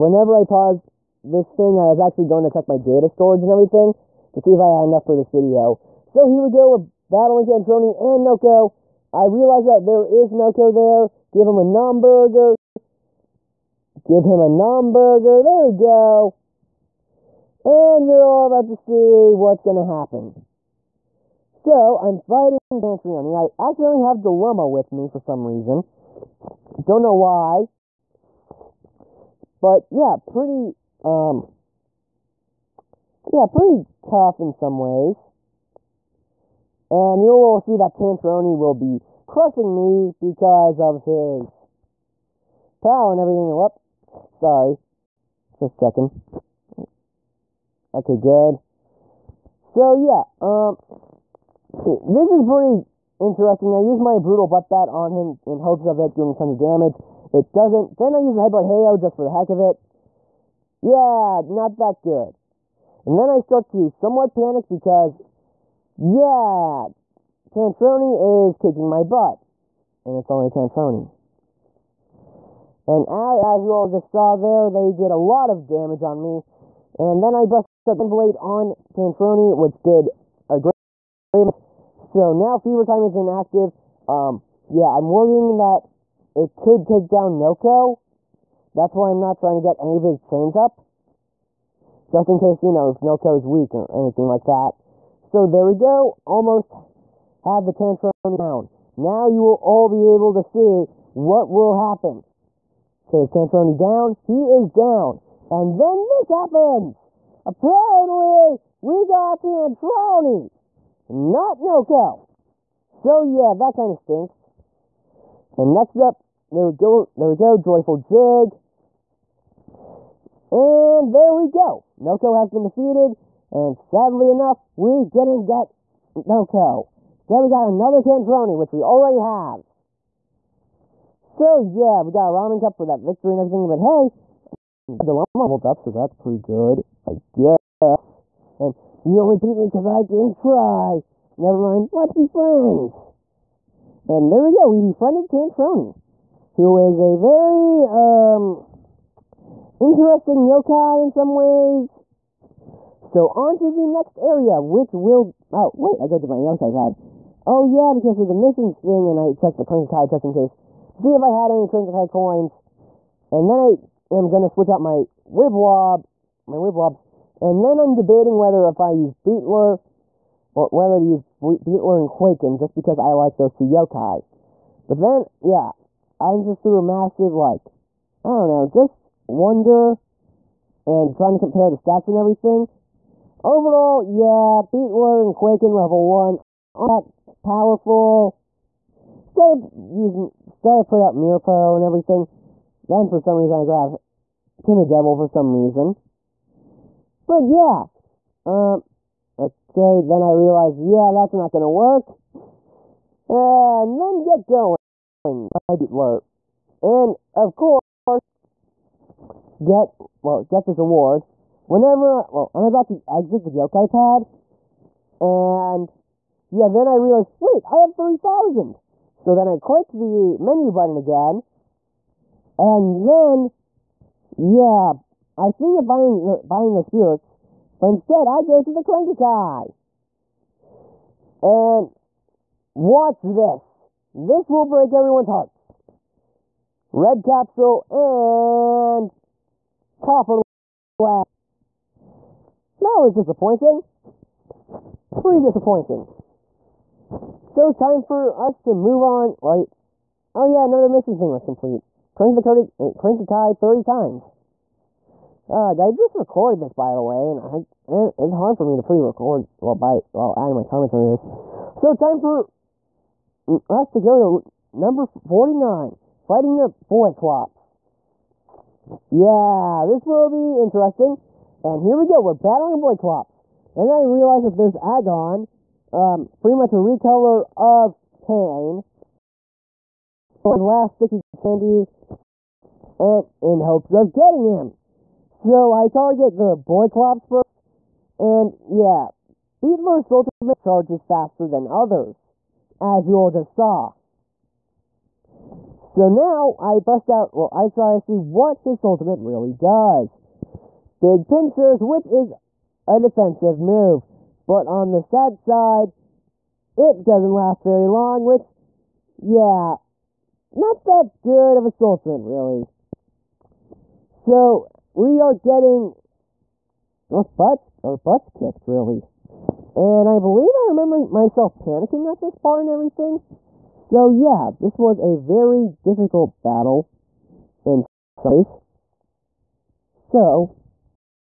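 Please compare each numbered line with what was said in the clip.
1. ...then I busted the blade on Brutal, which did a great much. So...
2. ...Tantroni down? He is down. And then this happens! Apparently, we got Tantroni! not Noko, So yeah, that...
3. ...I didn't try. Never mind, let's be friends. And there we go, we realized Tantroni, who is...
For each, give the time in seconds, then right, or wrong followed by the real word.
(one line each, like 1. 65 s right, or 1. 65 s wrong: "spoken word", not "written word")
1. 77 s wrong: "Tantroni", not "Brutal"
2. 103 s right
3. 139 s wrong: "befriended", not "realized".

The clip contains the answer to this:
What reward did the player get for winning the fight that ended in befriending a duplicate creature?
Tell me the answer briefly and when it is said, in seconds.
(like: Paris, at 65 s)
Ramen cup, at 132 s.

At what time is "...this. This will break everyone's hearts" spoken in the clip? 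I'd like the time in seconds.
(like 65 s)
233 s.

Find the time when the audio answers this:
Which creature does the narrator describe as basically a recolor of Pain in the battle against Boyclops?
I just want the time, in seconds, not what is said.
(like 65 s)
274 s.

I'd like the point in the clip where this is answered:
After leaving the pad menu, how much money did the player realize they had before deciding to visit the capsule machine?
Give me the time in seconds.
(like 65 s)
217 s.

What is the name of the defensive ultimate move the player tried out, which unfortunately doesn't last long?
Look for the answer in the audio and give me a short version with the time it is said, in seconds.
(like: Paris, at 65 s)
Big pincers, at 300 s.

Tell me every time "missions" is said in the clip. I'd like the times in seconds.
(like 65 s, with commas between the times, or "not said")
158 s, 250 s.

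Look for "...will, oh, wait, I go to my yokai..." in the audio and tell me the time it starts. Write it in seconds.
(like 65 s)
154 s.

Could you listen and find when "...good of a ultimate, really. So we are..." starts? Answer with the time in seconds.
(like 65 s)
311 s.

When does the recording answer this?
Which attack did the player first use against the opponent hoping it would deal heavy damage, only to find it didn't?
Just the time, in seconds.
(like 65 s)
54 s.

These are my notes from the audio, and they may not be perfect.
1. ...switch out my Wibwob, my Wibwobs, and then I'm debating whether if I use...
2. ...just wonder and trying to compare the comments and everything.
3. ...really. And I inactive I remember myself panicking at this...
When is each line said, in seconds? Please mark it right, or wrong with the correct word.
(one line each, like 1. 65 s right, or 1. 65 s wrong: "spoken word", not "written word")
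1. 164 s right
2. 178 s wrong: "stats", not "comments"
3. 318 s wrong: "believe", not "inactive".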